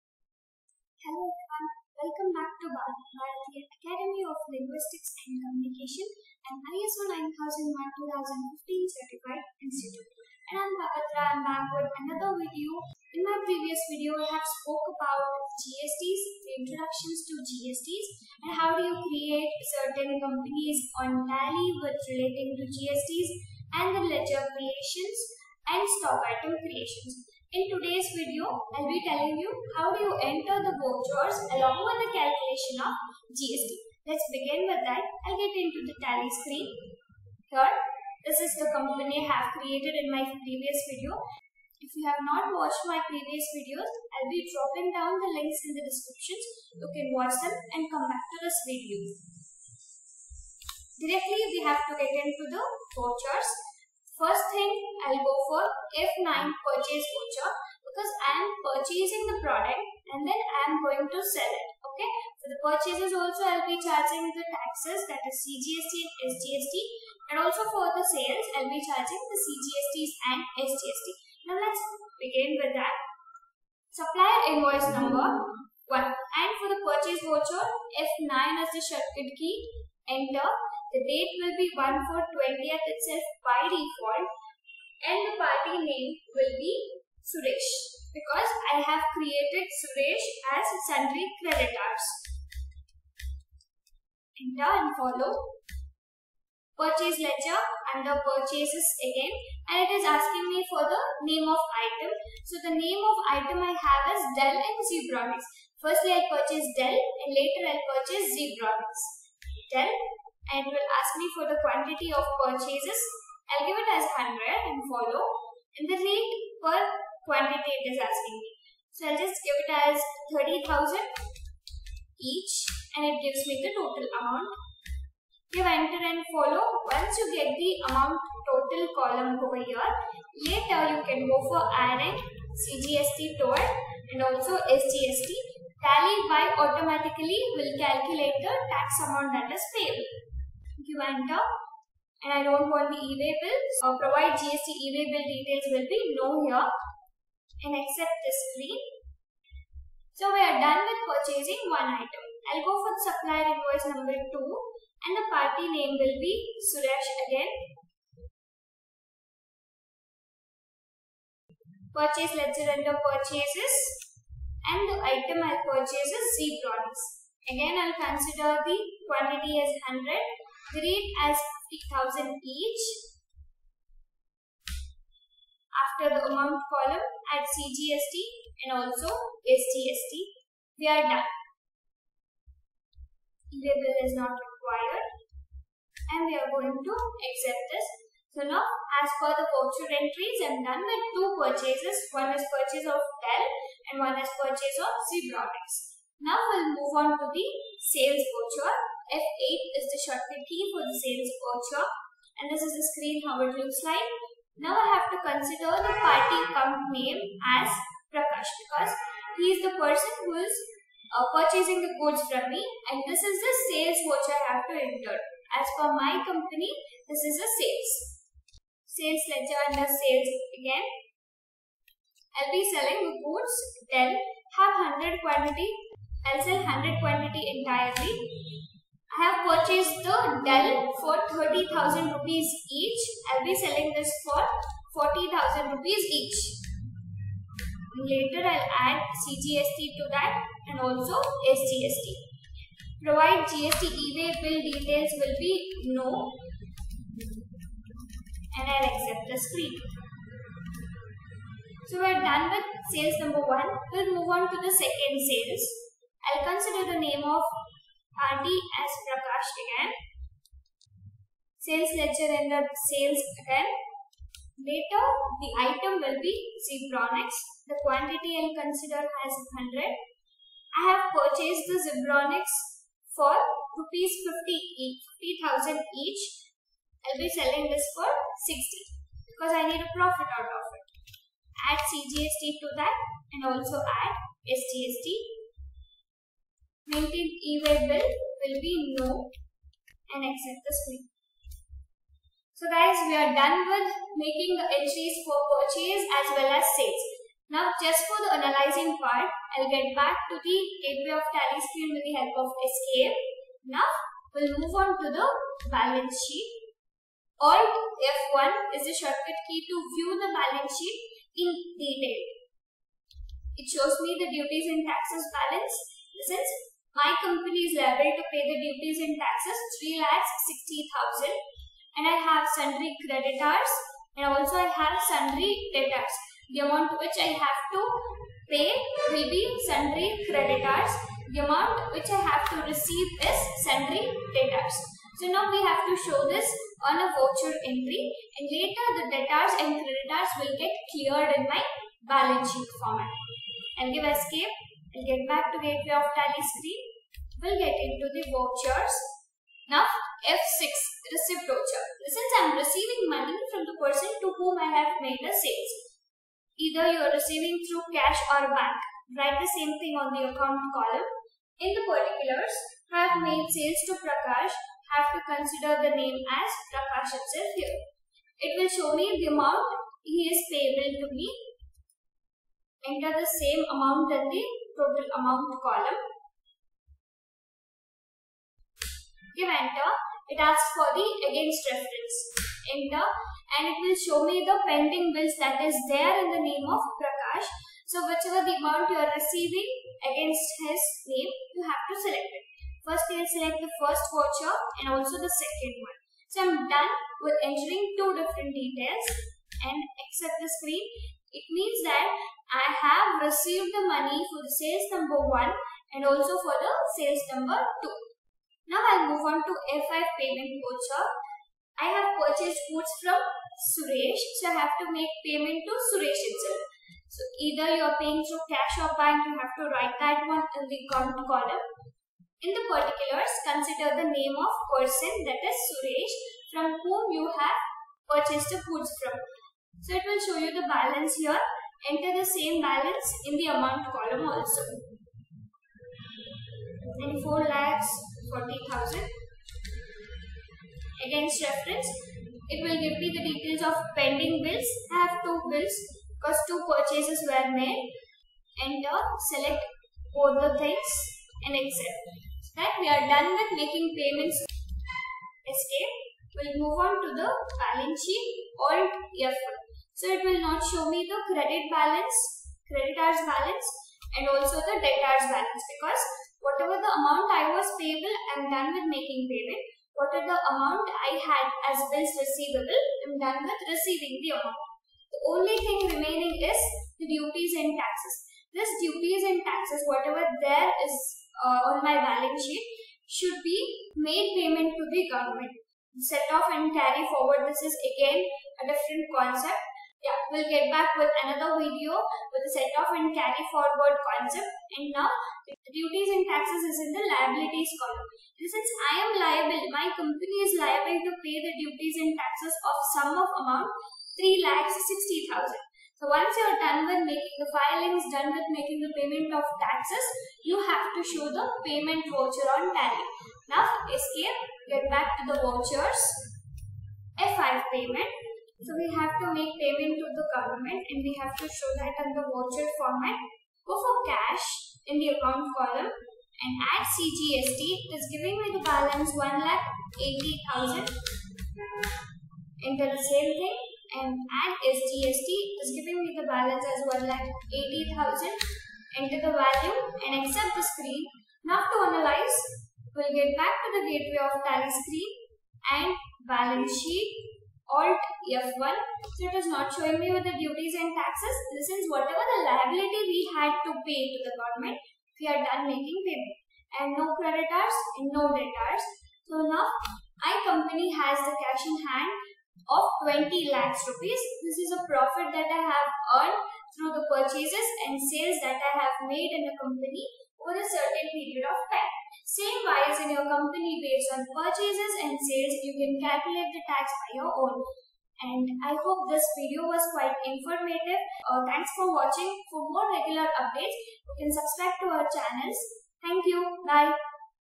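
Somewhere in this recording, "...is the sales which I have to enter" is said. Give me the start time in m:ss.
3:33.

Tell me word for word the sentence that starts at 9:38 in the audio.
And I hope this video was quite informative.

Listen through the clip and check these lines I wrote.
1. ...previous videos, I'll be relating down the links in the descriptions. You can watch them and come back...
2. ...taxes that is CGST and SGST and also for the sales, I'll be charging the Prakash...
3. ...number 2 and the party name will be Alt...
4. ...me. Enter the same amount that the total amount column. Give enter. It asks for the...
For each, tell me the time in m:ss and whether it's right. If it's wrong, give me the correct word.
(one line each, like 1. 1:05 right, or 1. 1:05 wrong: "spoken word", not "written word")
1. 0:43 wrong: "dropping", not "relating"
2. 1:04 wrong: "CGSTs", not "Prakash"
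3. 2:33 wrong: "Suresh", not "Alt"
4. 6:11 right.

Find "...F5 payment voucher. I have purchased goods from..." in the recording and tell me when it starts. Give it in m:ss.
6:49.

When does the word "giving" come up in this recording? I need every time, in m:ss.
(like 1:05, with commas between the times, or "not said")
8:48, 8:55.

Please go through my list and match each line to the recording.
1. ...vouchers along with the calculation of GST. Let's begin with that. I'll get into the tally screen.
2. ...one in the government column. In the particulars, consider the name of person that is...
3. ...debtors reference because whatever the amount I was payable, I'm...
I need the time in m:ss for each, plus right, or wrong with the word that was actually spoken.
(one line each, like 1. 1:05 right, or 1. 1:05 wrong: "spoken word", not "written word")
1. 0:30 right
2. 7:00 wrong: "count", not "government"
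3. 7:44 wrong: "balance", not "reference".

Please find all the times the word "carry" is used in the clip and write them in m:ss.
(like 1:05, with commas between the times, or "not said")
8:06, 8:13.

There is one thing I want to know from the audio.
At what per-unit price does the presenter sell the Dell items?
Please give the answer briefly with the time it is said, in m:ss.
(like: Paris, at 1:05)
40,000, at 3:55.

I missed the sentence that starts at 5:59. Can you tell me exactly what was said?
Write the same thing on the account column.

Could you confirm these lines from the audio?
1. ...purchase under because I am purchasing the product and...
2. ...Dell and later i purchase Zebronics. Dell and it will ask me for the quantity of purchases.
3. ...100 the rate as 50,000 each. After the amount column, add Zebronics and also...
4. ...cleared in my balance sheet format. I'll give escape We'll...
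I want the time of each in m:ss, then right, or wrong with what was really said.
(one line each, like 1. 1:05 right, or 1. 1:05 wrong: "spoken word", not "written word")
1. 0:56 wrong: "voucher", not "under"
2. 1:46 right
3. 2:49 wrong: "CGST", not "Zebronics"
4. 5:40 right.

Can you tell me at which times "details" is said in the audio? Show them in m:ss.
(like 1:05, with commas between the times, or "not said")
2:25, 4:04, 5:11, 6:38, 7:23.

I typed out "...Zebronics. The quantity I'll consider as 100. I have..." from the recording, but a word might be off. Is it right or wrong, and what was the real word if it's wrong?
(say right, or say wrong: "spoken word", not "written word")
right.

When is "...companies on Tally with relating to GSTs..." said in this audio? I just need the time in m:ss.
0:20.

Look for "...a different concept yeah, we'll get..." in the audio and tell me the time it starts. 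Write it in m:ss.
8:08.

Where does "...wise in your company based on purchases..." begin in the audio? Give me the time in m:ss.
9:32.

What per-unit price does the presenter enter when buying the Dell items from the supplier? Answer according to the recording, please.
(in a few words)
30,000.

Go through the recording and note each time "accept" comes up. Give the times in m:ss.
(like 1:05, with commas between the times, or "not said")
2:27, 3:06, 4:08, 4:50, 6:39, 7:31, 9:00.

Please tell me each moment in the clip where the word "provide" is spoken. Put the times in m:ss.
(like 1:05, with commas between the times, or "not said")
2:23, 4:03.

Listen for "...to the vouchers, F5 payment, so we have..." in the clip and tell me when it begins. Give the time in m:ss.
8:35.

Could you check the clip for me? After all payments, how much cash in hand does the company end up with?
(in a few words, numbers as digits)
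20 lakhs.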